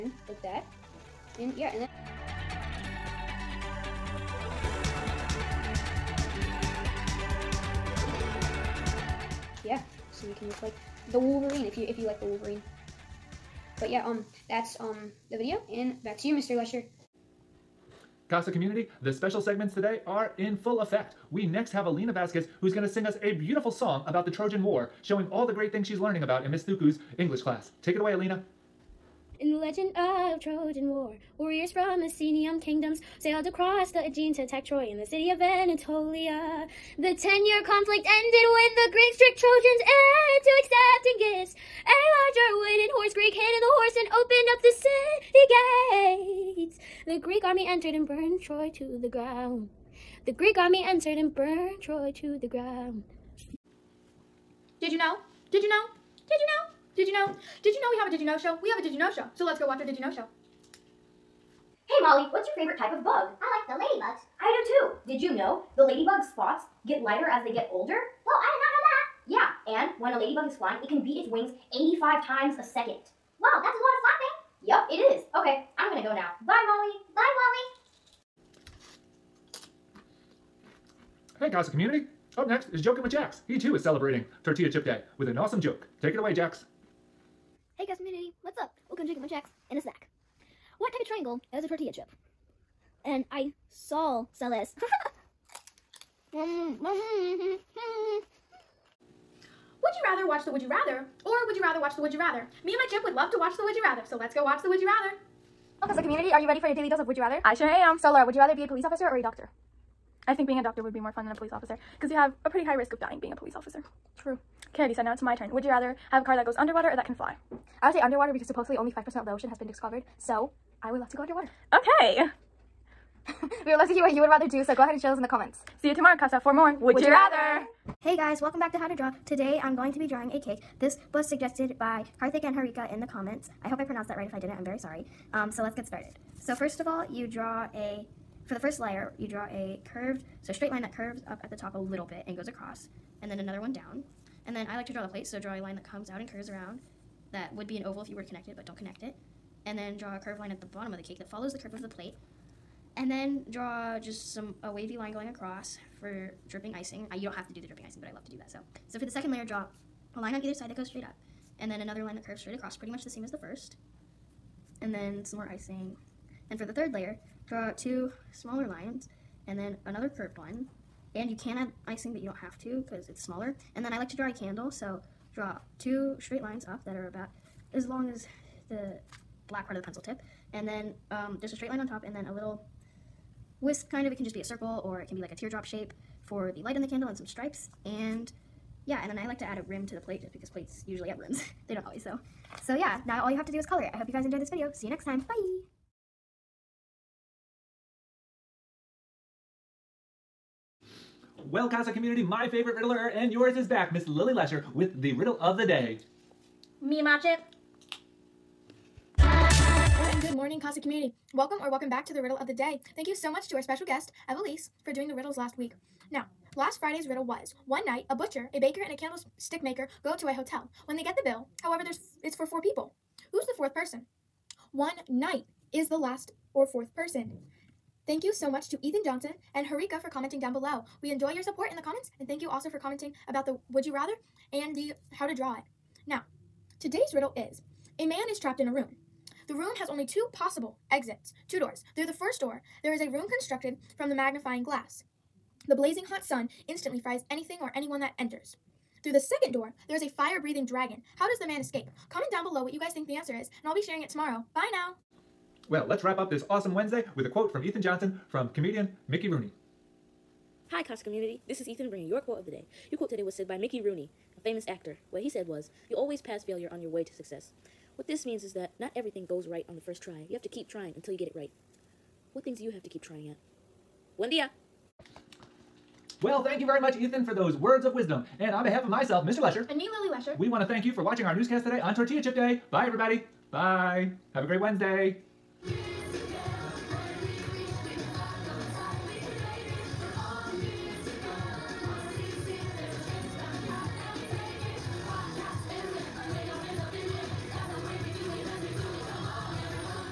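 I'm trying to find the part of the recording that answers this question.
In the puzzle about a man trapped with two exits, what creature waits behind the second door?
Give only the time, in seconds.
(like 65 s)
250 s.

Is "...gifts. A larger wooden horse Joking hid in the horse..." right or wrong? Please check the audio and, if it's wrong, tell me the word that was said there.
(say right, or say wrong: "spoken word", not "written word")
wrong: "Greek", not "Joking".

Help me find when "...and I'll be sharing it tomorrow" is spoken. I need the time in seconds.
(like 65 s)
253 s.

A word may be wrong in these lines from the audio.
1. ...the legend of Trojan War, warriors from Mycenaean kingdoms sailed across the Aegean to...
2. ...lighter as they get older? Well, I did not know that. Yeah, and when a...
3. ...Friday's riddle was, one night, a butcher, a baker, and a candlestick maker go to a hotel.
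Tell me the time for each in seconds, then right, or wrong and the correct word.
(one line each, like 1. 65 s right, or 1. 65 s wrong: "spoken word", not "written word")
1. 29 s right
2. 67 s right
3. 216 s right.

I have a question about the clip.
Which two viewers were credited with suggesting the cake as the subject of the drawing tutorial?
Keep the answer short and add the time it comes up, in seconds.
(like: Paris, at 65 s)
Karthik and Harika, at 132 s.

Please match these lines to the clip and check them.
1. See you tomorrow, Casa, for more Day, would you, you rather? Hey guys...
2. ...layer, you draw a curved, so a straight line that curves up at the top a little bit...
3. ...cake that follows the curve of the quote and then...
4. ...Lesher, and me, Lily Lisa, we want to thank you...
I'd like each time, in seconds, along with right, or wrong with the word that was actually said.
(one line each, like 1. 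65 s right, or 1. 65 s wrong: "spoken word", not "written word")
1. 125 s wrong: "Would", not "Day"
2. 138 s right
3. 151 s wrong: "plate", not "quote"
4. 279 s wrong: "Lesher", not "Lisa".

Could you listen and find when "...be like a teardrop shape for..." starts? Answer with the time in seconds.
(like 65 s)
185 s.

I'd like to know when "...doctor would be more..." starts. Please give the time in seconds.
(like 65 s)
110 s.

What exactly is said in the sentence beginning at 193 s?
I hope you guys enjoyed this video.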